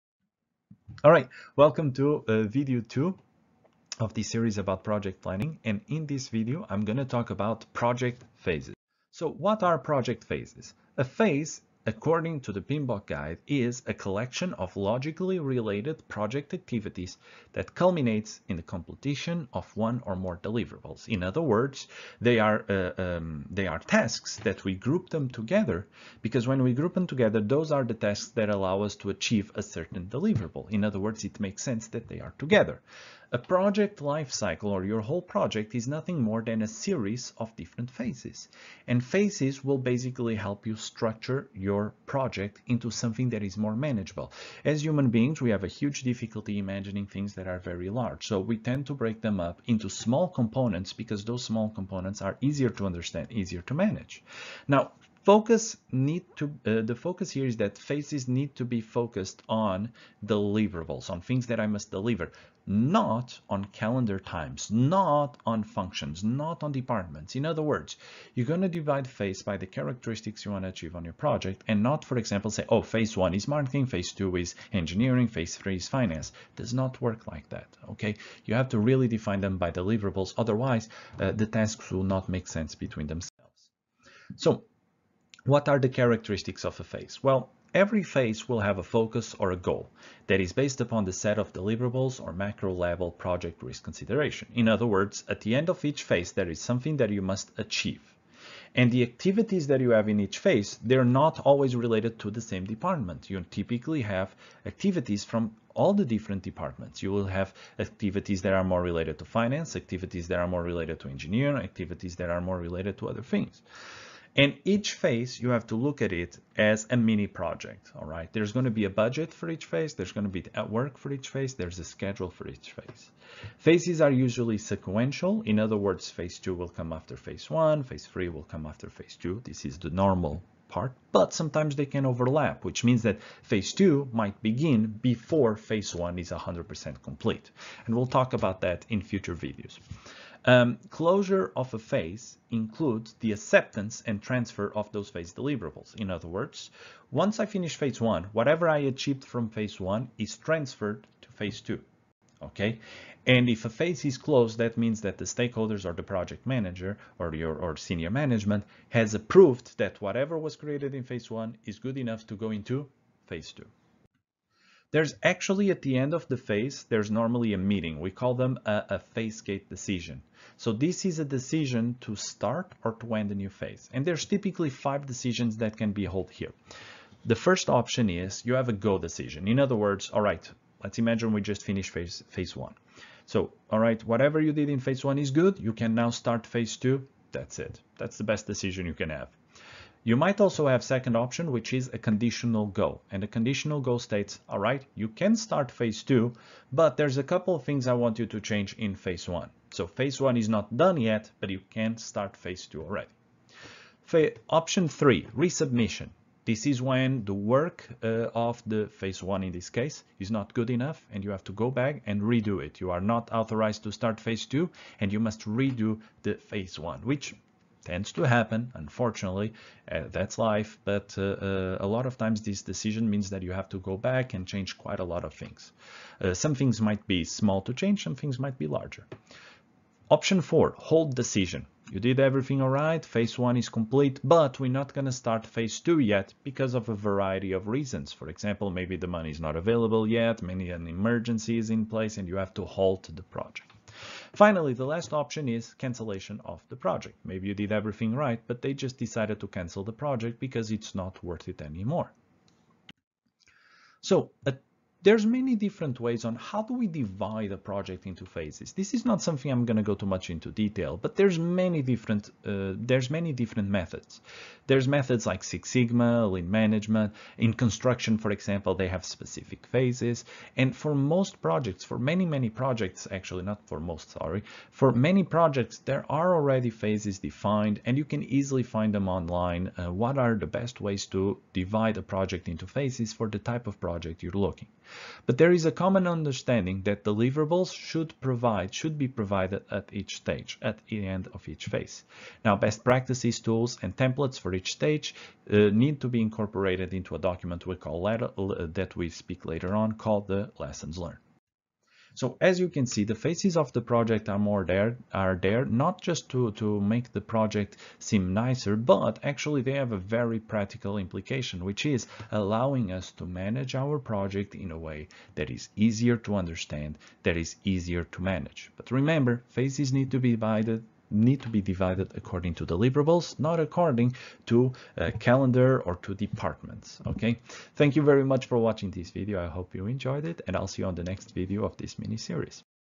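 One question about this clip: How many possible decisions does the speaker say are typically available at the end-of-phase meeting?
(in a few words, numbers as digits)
5.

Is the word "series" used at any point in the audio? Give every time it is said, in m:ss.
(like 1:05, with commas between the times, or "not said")
0:04, 0:36, 5:32.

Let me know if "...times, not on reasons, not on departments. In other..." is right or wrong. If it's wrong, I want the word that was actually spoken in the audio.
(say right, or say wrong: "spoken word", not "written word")
wrong: "functions", not "reasons".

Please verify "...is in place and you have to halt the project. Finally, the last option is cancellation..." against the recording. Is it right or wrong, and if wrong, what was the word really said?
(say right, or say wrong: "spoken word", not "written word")
right.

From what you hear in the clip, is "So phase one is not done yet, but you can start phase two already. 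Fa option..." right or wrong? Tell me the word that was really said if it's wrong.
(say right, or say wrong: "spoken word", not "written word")
right.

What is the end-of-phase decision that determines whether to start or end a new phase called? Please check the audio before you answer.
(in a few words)
phase gate decision.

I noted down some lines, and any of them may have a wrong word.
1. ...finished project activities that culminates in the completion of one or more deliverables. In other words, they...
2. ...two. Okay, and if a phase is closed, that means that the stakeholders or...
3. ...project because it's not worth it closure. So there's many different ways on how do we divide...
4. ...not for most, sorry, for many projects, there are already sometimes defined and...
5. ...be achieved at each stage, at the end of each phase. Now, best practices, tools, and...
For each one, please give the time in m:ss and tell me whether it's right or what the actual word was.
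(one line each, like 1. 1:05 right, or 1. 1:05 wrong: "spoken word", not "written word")
1. 0:15 wrong: "related", not "finished"
2. 2:31 right
3. 4:09 wrong: "anymore", not "closure"
4. 4:33 wrong: "phases", not "sometimes"
5. 4:48 wrong: "provided", not "achieved".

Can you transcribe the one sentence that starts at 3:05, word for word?
You can now start phase two.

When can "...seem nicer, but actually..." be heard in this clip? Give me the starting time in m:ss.
5:07.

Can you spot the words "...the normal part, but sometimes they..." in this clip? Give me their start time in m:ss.
2:09.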